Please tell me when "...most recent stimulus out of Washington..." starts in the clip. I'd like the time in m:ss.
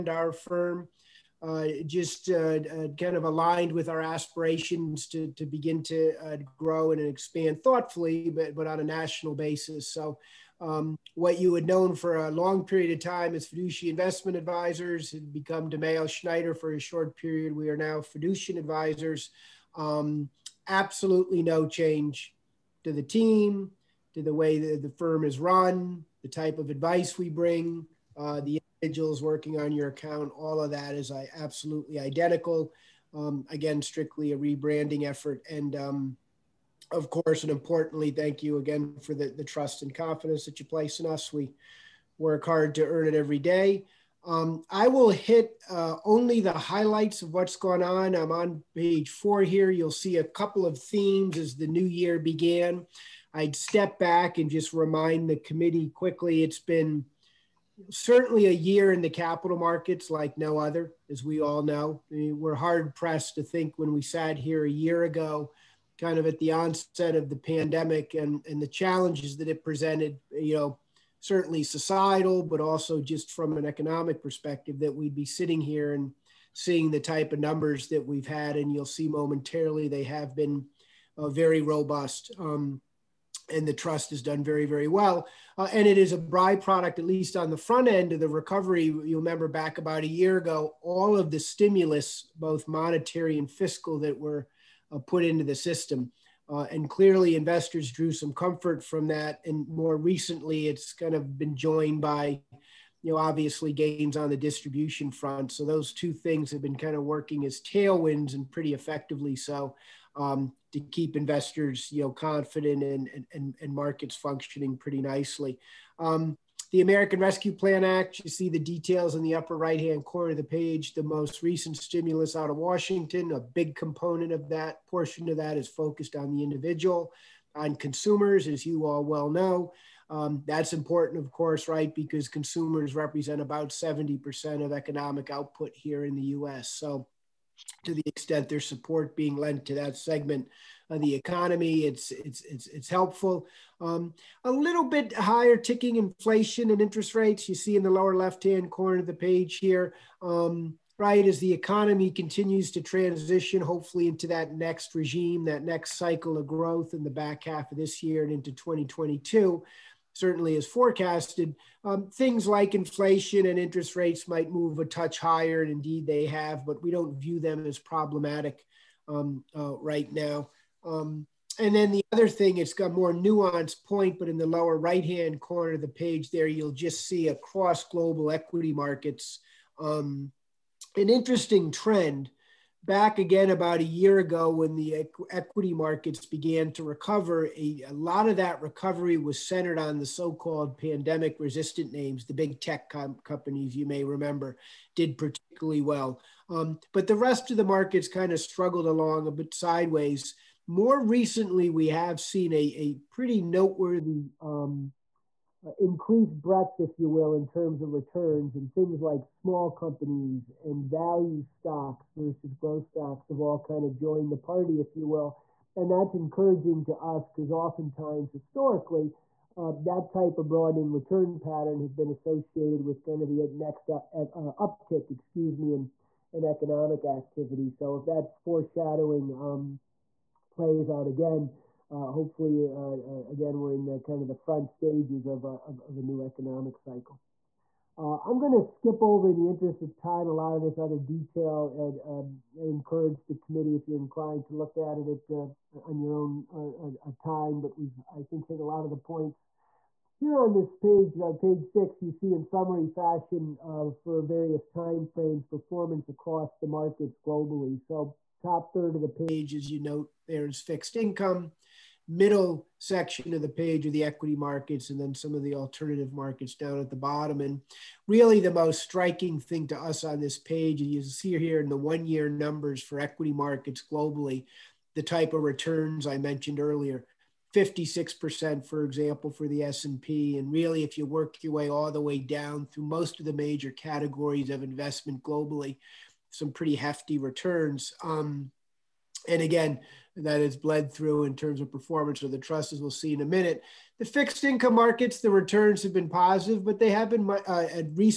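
2:01.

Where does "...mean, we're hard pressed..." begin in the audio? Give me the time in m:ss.
1:02.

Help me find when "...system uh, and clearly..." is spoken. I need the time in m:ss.
1:35.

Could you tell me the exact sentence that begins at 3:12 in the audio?
The big tech com- companies, you may remember, did particularly well.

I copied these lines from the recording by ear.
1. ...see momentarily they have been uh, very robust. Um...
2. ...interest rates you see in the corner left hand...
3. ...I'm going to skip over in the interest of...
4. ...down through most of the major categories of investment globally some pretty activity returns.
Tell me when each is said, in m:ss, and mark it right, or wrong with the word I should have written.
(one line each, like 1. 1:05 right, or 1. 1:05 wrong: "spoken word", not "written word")
1. 1:18 right
2. 2:26 wrong: "lower", not "corner"
3. 3:58 right
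4. 4:42 wrong: "hefty", not "activity".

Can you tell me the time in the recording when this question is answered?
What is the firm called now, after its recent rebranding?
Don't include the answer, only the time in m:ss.
0:17.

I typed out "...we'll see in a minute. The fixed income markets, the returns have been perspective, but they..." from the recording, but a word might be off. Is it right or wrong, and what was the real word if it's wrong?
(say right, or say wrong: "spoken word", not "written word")
wrong: "positive", not "perspective".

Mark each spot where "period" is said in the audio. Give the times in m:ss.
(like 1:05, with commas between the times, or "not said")
0:12, 0:17.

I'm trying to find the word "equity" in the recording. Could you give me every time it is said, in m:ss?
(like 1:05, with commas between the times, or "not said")
2:58, 3:05, 4:24, 4:33.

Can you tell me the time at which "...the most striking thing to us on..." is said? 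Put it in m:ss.
4:28.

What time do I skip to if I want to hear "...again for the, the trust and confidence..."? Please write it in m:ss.
0:38.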